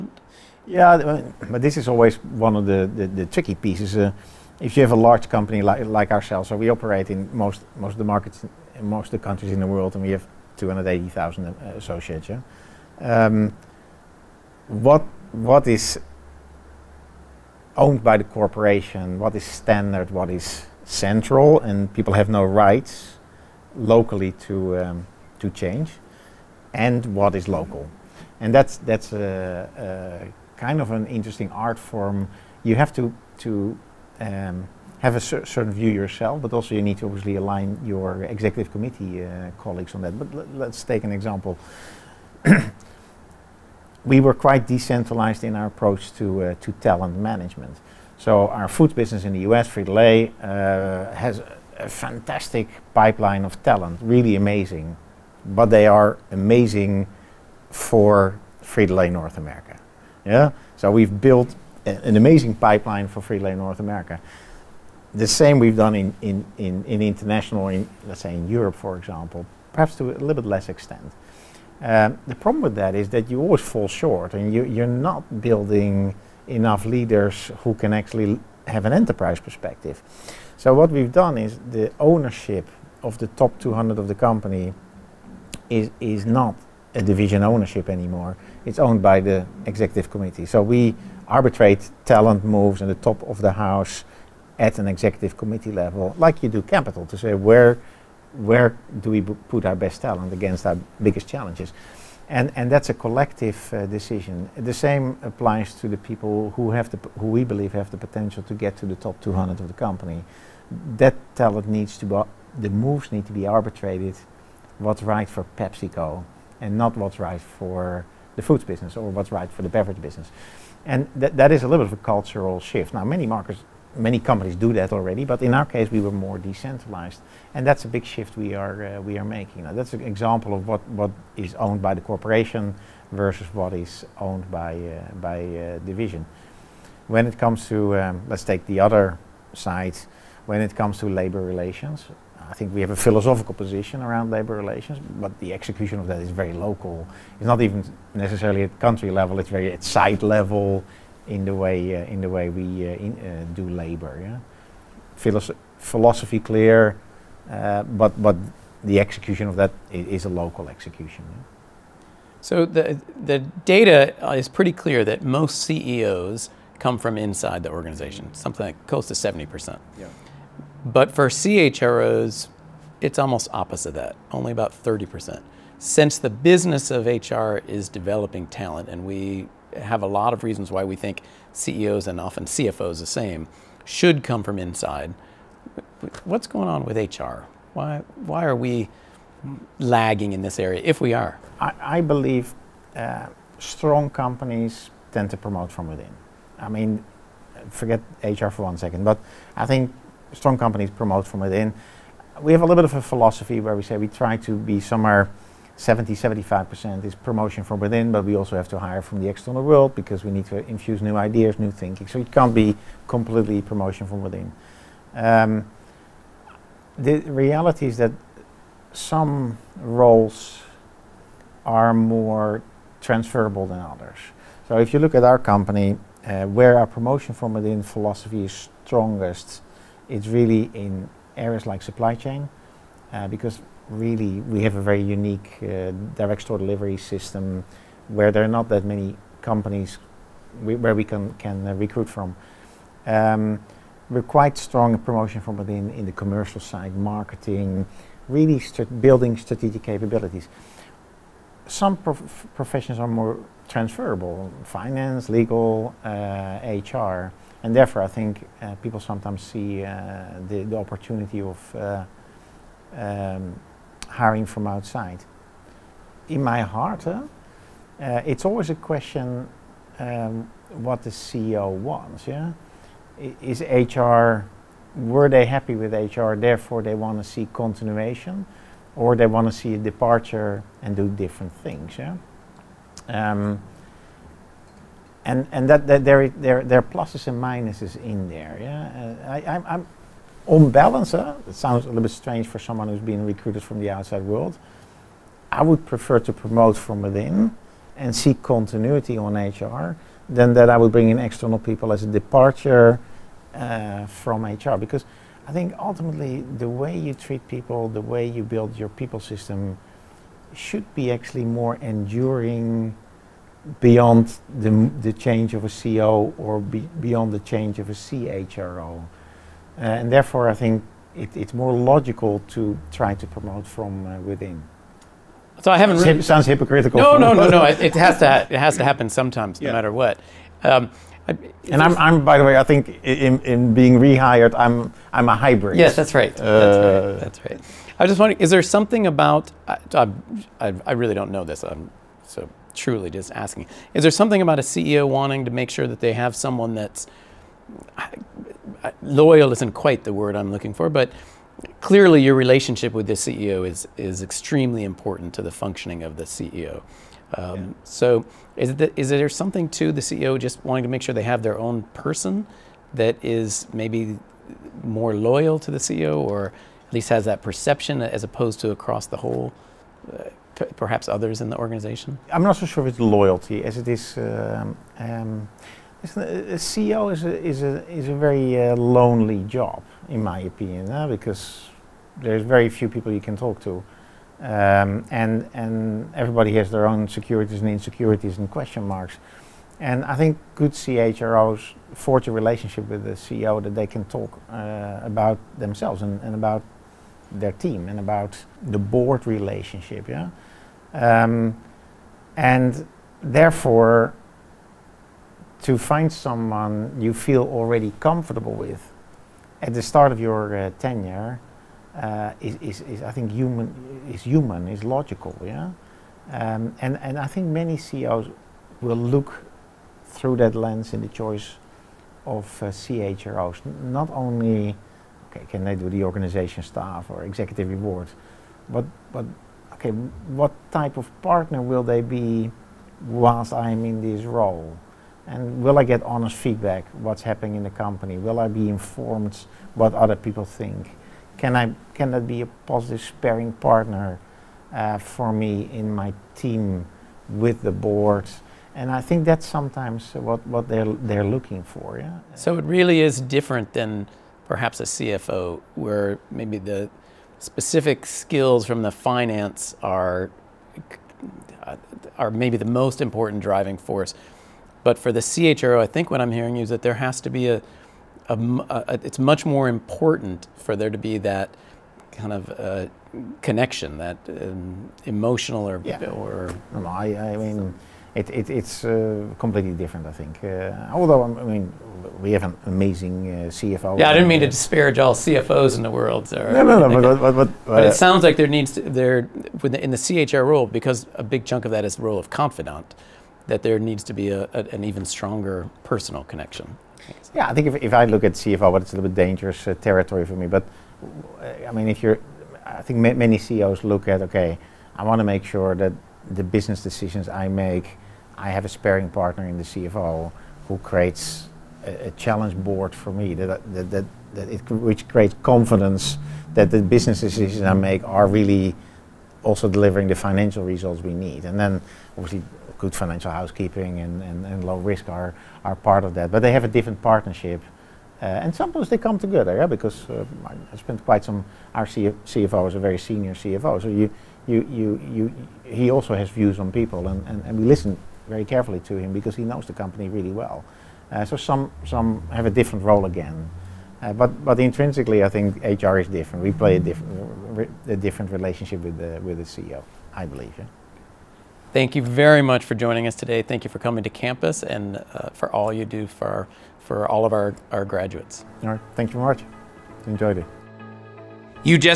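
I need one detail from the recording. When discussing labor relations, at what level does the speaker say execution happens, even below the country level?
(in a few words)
site level.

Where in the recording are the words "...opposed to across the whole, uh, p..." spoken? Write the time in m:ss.
6:08.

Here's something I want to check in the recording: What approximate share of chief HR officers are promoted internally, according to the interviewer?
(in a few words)
30 percent.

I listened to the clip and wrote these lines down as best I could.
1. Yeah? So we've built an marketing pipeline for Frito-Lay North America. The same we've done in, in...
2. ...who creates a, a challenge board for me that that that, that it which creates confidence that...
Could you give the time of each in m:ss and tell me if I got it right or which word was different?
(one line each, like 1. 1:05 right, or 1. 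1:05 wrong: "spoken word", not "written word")
1. 1:00 wrong: "amazing", not "marketing"
2. 8:30 right.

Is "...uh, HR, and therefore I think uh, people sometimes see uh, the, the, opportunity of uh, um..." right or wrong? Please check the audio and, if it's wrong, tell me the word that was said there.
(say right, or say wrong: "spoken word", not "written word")
right.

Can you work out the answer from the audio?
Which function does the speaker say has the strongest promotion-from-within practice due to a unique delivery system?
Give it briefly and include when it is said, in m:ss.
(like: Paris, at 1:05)
supply chain, at 3:51.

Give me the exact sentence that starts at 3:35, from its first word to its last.
Um, the reality is that some roles are more transferable than others.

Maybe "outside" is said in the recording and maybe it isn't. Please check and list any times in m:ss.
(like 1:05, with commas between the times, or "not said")
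4:24, 4:53.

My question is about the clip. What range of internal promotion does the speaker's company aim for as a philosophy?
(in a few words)
70-75%.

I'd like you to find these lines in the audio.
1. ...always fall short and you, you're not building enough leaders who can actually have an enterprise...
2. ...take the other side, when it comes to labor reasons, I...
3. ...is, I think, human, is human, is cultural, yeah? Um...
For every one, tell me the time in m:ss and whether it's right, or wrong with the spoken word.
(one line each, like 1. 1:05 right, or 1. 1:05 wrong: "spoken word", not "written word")
1. 1:13 right
2. 2:18 wrong: "relations", not "reasons"
3. 6:52 wrong: "logical", not "cultural".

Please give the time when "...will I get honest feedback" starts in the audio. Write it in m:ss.
7:15.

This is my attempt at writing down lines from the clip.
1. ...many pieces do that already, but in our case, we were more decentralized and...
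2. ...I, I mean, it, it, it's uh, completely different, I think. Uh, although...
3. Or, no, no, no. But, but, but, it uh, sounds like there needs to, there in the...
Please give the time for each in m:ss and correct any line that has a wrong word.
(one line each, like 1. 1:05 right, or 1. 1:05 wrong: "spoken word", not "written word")
1. 2:03 wrong: "companies", not "pieces"
2. 7:56 right
3. 8:06 right.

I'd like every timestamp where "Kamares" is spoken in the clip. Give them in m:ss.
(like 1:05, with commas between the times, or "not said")
not said.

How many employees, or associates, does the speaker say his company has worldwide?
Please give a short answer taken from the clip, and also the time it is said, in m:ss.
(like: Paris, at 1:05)
280,000, at 0:10.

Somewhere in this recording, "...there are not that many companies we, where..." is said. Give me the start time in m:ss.
3:58.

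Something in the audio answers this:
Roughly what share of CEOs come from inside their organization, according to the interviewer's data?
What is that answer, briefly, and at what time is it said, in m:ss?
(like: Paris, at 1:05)
70 percent, at 2:48.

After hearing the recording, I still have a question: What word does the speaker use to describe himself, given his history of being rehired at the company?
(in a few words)
hybrid.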